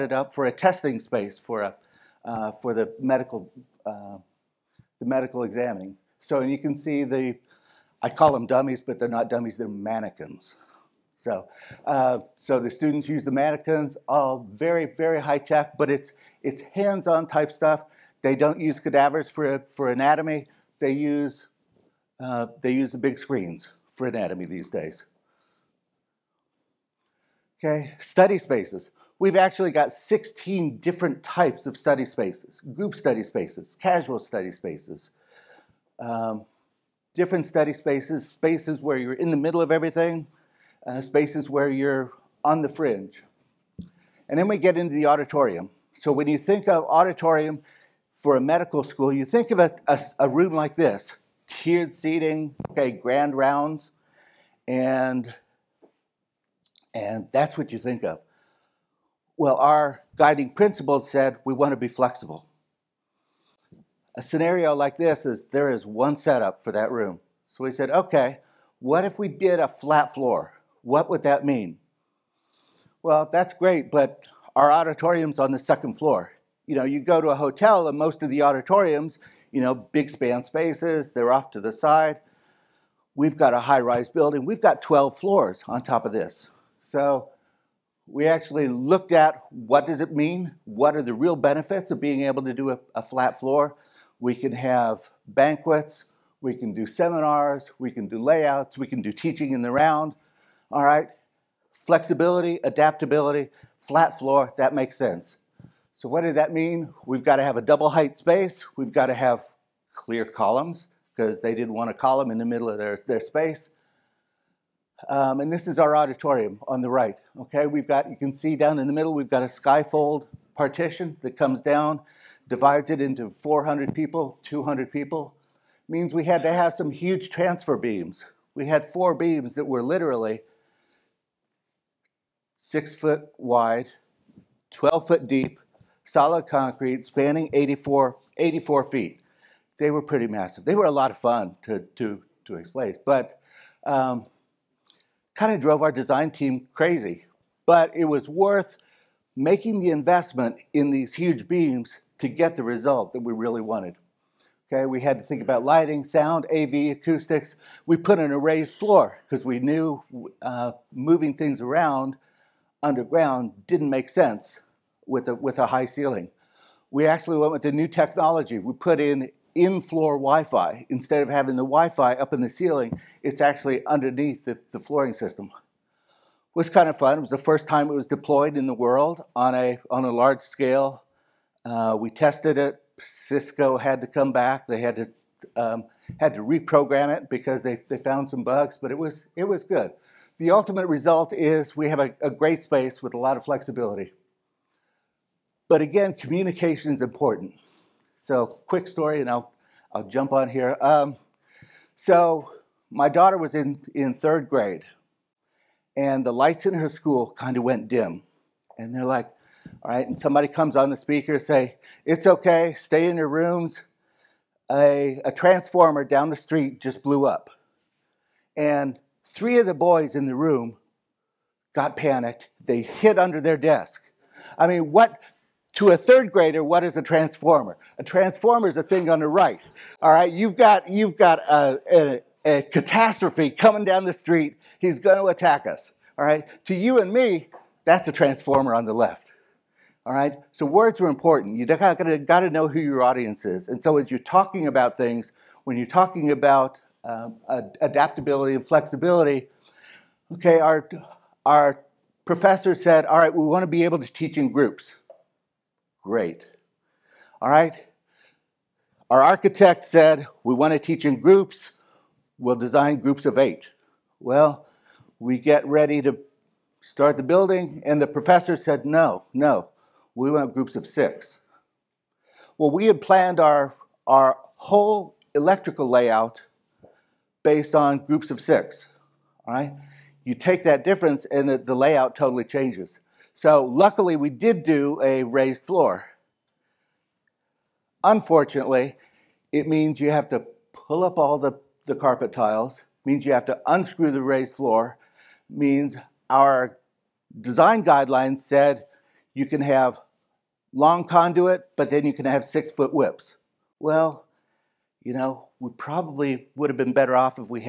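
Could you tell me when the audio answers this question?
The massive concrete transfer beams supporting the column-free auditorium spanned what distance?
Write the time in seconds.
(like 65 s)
138 s.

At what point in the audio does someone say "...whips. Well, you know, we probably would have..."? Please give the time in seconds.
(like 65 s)
302 s.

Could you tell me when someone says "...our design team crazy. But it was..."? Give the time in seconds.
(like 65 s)
145 s.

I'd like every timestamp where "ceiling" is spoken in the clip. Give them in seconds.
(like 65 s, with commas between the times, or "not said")
165 s, 172 s.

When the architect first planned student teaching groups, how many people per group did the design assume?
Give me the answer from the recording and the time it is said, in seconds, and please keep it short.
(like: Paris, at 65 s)
8, at 263 s.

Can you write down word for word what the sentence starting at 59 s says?
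Well, our guiding principle said we want to be flexible.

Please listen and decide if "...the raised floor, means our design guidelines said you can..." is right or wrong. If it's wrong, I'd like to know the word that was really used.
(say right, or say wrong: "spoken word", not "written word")
right.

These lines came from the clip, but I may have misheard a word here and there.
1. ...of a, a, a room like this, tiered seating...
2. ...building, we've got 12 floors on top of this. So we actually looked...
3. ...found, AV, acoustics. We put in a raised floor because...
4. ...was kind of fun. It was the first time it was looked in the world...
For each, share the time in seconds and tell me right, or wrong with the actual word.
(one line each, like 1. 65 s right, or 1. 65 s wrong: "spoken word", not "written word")
1. 49 s right
2. 84 s right
3. 156 s wrong: "sound", not "found"
4. 176 s wrong: "deployed", not "looked".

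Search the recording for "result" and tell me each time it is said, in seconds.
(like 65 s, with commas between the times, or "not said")
152 s, 190 s.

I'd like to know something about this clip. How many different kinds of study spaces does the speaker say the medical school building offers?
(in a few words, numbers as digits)
16.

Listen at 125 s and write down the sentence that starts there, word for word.
It means we had to have some huge transfer beams.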